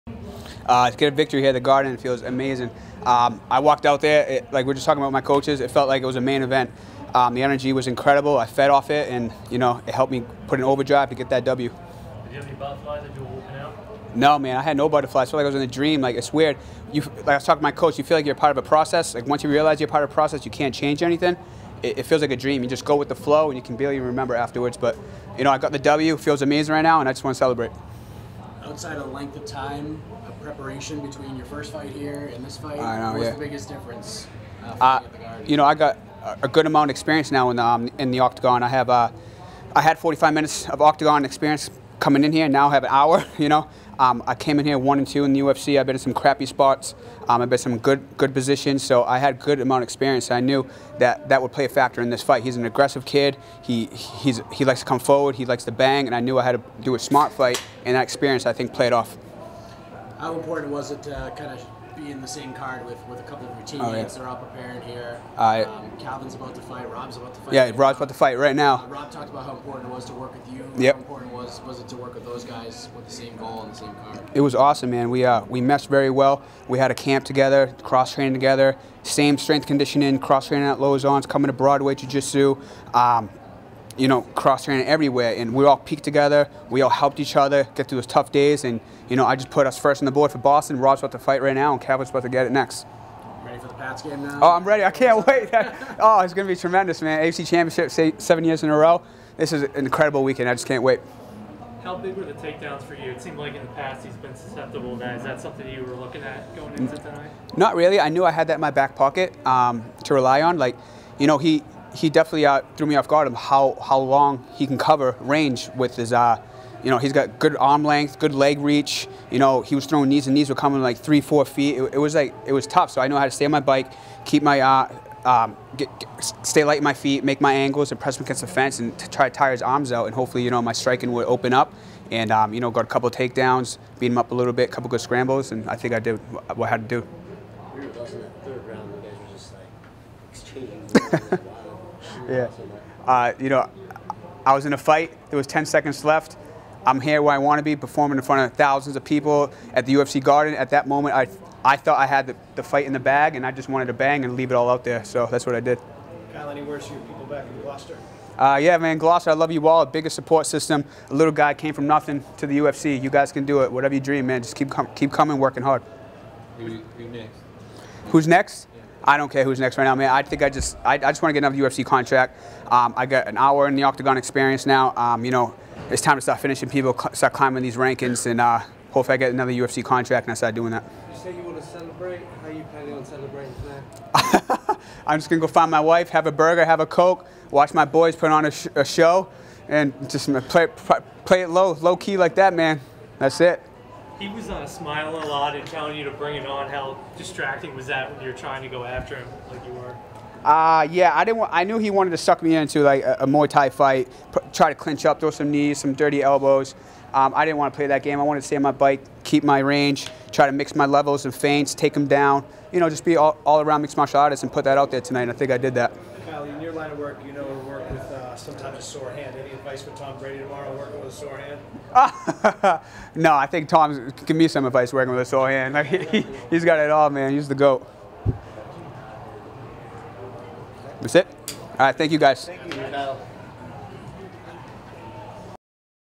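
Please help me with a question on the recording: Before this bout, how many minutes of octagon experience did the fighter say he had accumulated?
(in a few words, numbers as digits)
45.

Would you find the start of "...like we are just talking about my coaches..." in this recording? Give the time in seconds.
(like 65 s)
4 s.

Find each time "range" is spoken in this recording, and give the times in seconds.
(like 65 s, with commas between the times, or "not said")
115 s, 209 s.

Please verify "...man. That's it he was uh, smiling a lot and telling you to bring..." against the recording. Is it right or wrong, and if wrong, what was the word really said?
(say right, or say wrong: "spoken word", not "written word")
right.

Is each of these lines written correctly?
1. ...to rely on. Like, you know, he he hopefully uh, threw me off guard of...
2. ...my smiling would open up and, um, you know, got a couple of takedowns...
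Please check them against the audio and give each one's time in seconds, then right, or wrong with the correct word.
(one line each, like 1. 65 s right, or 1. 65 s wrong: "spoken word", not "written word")
1. 110 s wrong: "definitely", not "hopefully"
2. 130 s wrong: "striking", not "smiling".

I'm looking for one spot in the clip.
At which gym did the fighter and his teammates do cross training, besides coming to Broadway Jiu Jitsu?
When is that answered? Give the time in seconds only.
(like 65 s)
80 s.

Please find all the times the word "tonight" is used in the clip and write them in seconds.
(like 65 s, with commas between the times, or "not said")
106 s, 183 s, 215 s.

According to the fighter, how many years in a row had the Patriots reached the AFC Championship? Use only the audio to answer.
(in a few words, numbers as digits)
7.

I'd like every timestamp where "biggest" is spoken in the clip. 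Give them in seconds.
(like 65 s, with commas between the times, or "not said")
33 s, 159 s.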